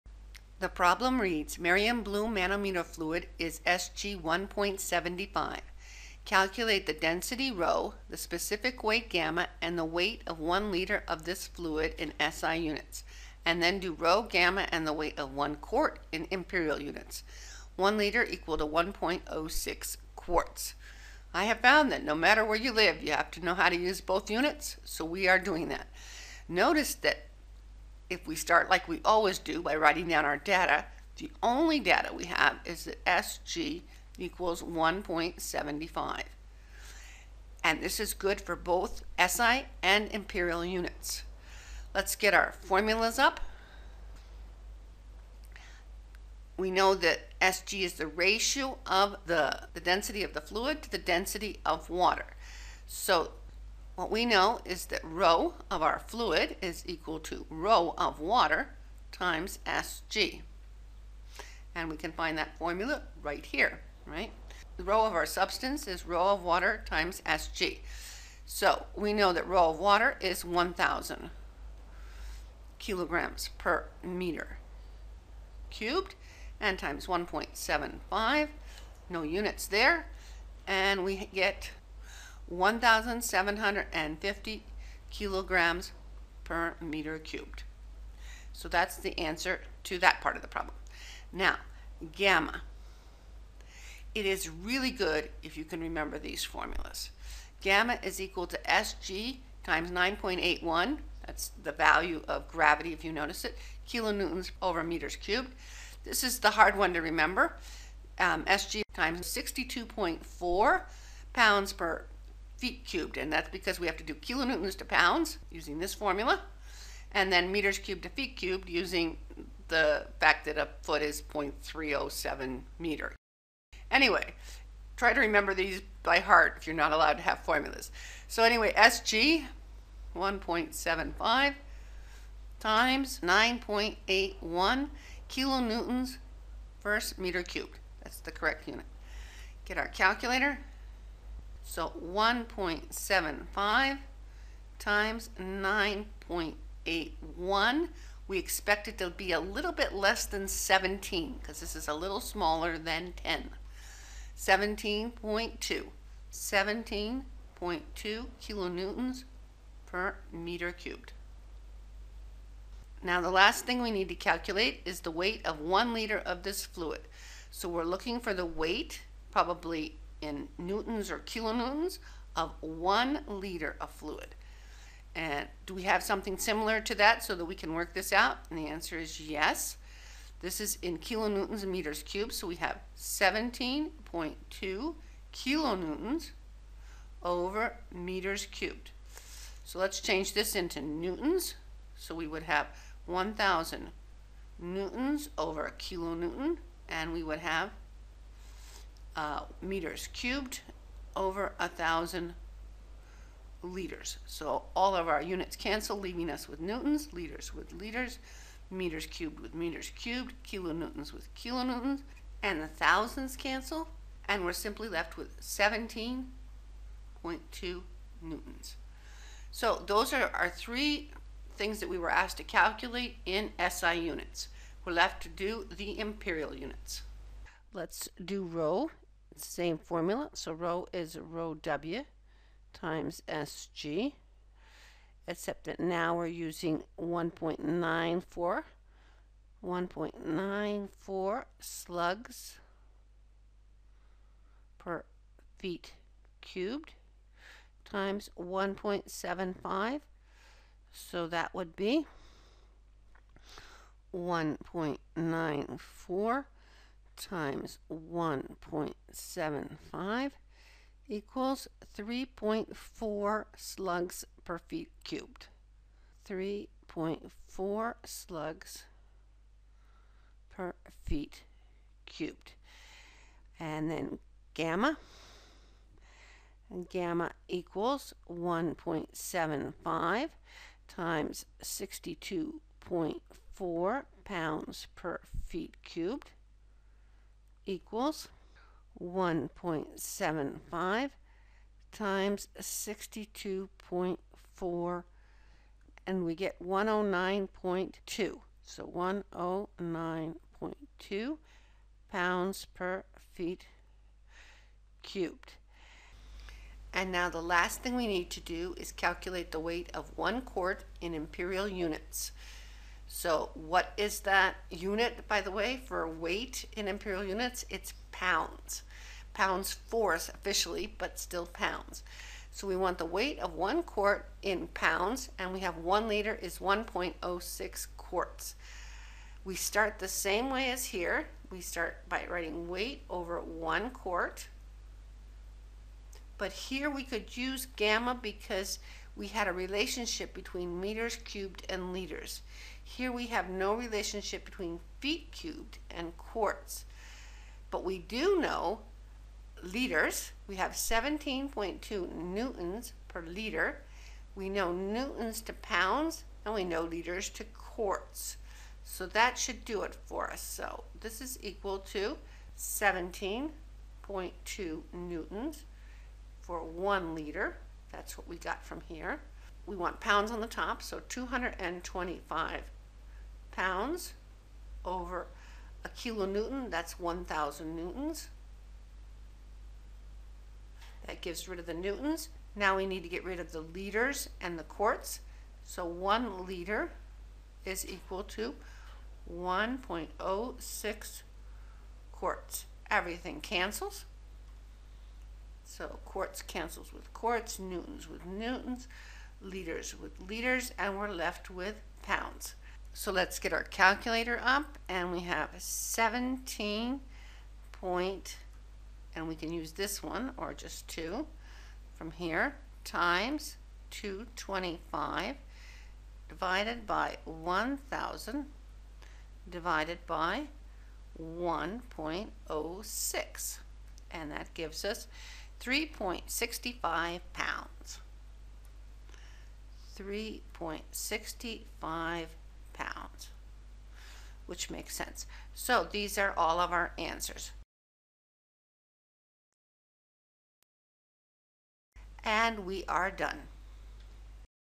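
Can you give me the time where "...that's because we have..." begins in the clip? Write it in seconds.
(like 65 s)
113 s.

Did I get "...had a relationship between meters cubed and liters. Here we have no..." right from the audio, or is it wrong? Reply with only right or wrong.
right.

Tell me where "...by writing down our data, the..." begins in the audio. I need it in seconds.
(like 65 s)
29 s.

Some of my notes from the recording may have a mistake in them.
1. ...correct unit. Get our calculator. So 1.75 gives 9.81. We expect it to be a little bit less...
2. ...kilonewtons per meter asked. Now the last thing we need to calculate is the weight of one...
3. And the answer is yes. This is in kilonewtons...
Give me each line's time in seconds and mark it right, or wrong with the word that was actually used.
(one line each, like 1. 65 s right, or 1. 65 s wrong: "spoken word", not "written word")
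1. 138 s wrong: "times", not "gives"
2. 158 s wrong: "cubed", not "asked"
3. 178 s right.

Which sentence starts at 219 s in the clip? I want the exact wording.
So those are our three things that we were asked to calculate in SI units.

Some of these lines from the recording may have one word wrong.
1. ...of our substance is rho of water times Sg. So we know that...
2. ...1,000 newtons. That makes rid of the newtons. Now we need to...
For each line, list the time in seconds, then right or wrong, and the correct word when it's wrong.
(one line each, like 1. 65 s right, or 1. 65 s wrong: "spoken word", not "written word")
1. 65 s right
2. 376 s wrong: "gives", not "makes".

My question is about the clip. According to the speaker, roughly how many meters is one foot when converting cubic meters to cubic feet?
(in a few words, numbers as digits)
0.307.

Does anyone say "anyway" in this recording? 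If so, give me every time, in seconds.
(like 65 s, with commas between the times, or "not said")
123 s, 128 s.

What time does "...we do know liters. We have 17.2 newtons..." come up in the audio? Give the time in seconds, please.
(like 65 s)
347 s.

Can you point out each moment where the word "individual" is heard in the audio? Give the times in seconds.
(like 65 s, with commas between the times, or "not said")
not said.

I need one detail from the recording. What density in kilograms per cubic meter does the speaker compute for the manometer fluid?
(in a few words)
1,750.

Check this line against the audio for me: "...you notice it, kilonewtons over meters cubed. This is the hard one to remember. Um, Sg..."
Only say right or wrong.
right.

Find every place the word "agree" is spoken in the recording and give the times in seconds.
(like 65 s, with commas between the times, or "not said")
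not said.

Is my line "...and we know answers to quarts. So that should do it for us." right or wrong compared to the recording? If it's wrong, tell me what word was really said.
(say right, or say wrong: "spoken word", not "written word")
wrong: "liters", not "answers".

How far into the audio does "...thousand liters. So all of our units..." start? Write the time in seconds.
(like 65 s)
201 s.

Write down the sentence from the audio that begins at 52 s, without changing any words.
So what we know is that rho of our fluid is equal to rho of water times Sg.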